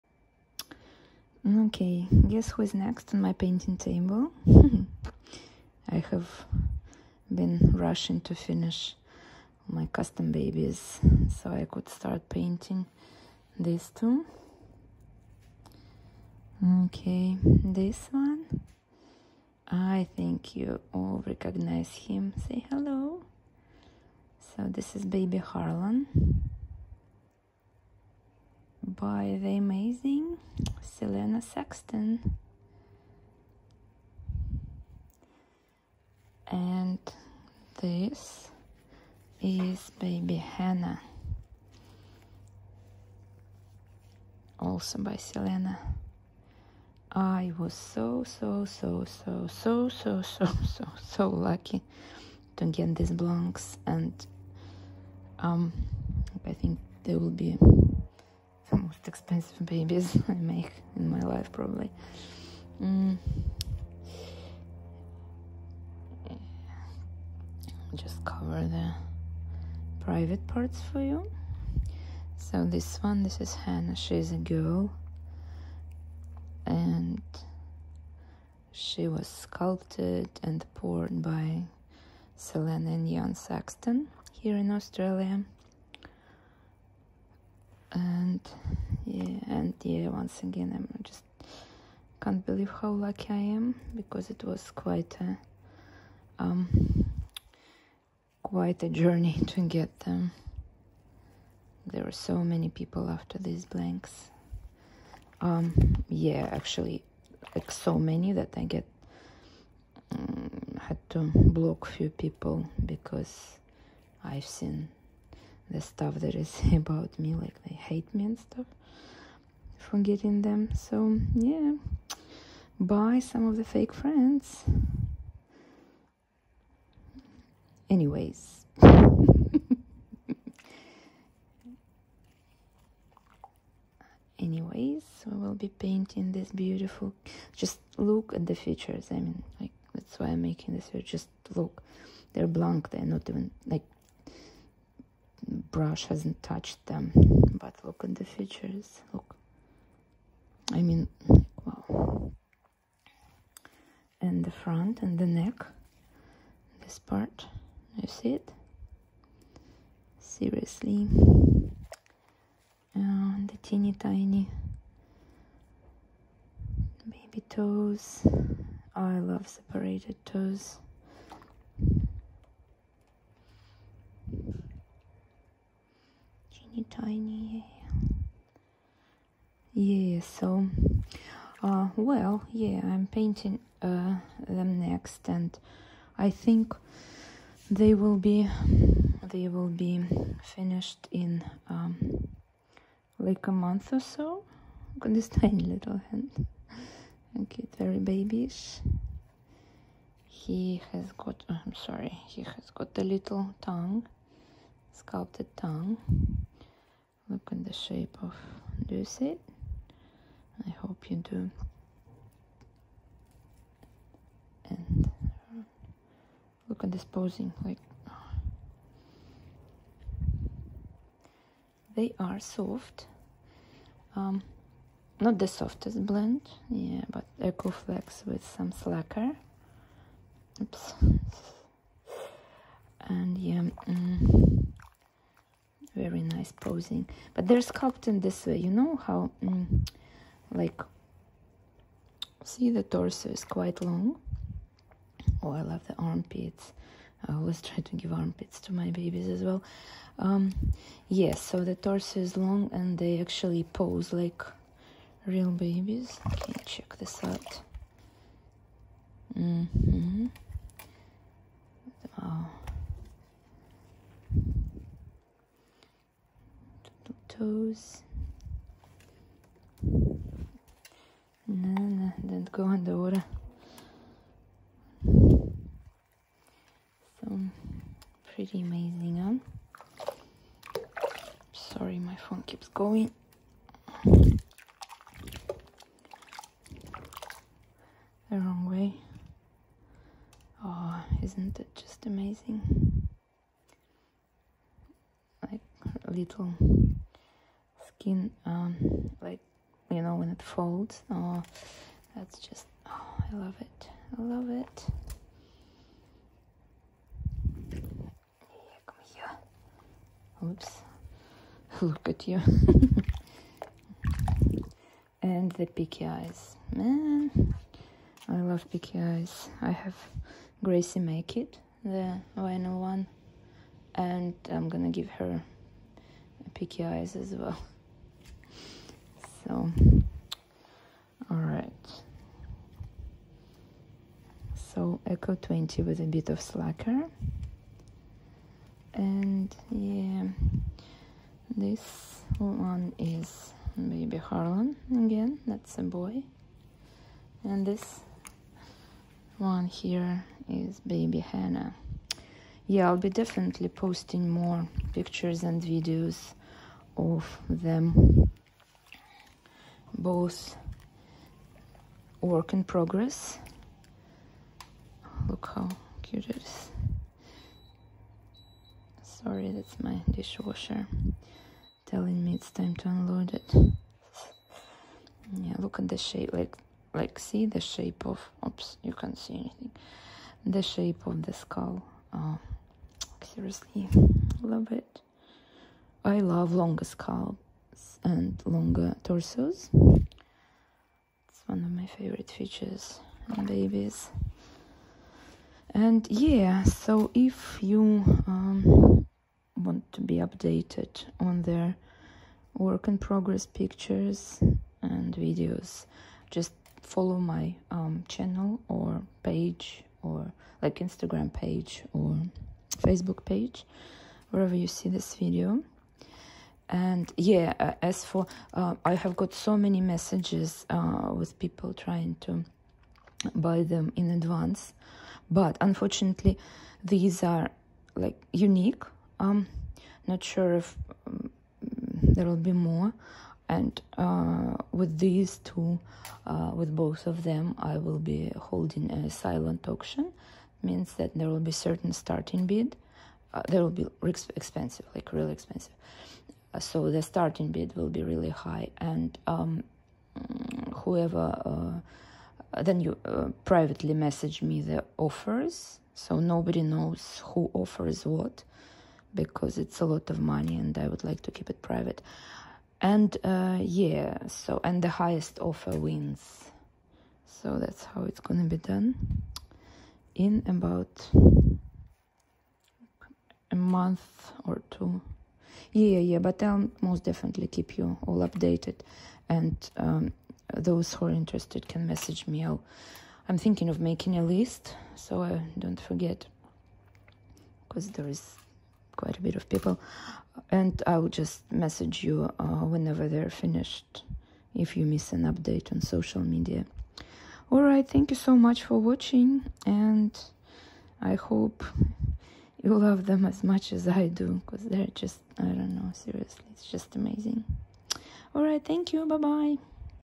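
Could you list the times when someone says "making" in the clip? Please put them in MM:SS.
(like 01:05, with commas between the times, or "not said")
02:20, 08:03.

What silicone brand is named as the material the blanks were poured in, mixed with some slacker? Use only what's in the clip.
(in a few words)
Ecoflex.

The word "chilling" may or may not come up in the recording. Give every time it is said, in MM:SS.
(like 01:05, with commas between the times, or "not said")
not said.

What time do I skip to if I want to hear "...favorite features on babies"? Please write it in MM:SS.
06:31.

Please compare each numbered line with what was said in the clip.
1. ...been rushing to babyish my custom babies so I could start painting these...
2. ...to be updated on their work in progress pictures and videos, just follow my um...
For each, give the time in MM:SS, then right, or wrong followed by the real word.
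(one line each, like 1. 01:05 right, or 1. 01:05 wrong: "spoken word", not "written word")
1. 00:07 wrong: "finish", not "babyish"
2. 06:39 right.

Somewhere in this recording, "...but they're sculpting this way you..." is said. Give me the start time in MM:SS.
03:57.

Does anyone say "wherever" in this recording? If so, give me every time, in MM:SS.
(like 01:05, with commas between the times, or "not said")
06:54.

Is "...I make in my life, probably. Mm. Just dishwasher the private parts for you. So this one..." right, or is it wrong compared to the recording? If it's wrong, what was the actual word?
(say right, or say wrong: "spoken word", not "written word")
wrong: "cover", not "dishwasher".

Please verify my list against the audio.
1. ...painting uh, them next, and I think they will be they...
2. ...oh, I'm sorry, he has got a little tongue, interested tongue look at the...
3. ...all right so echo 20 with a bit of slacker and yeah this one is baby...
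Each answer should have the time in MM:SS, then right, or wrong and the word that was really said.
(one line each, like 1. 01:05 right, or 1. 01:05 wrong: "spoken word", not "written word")
1. 03:03 right
2. 03:21 wrong: "sculpted", not "interested"
3. 05:31 right.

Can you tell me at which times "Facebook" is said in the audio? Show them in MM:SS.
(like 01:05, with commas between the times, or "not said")
06:52.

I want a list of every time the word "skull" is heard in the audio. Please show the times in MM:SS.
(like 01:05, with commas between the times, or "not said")
06:21, 06:26.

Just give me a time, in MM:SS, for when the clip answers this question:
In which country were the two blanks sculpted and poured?
01:24.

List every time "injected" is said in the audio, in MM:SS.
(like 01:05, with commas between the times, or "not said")
not said.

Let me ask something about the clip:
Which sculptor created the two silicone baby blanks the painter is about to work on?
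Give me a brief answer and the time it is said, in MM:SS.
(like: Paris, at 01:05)
Selena Saxton, at 00:30.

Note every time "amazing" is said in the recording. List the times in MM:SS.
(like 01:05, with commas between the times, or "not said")
00:29, 04:38, 04:52, 08:26.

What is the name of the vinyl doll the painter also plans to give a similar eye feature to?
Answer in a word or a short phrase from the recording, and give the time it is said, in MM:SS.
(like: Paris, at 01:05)
Gracie, at 05:20.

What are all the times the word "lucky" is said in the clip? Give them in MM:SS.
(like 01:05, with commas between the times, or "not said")
00:51, 01:32.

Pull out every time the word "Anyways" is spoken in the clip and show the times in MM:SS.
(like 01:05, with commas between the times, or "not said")
02:07, 02:14.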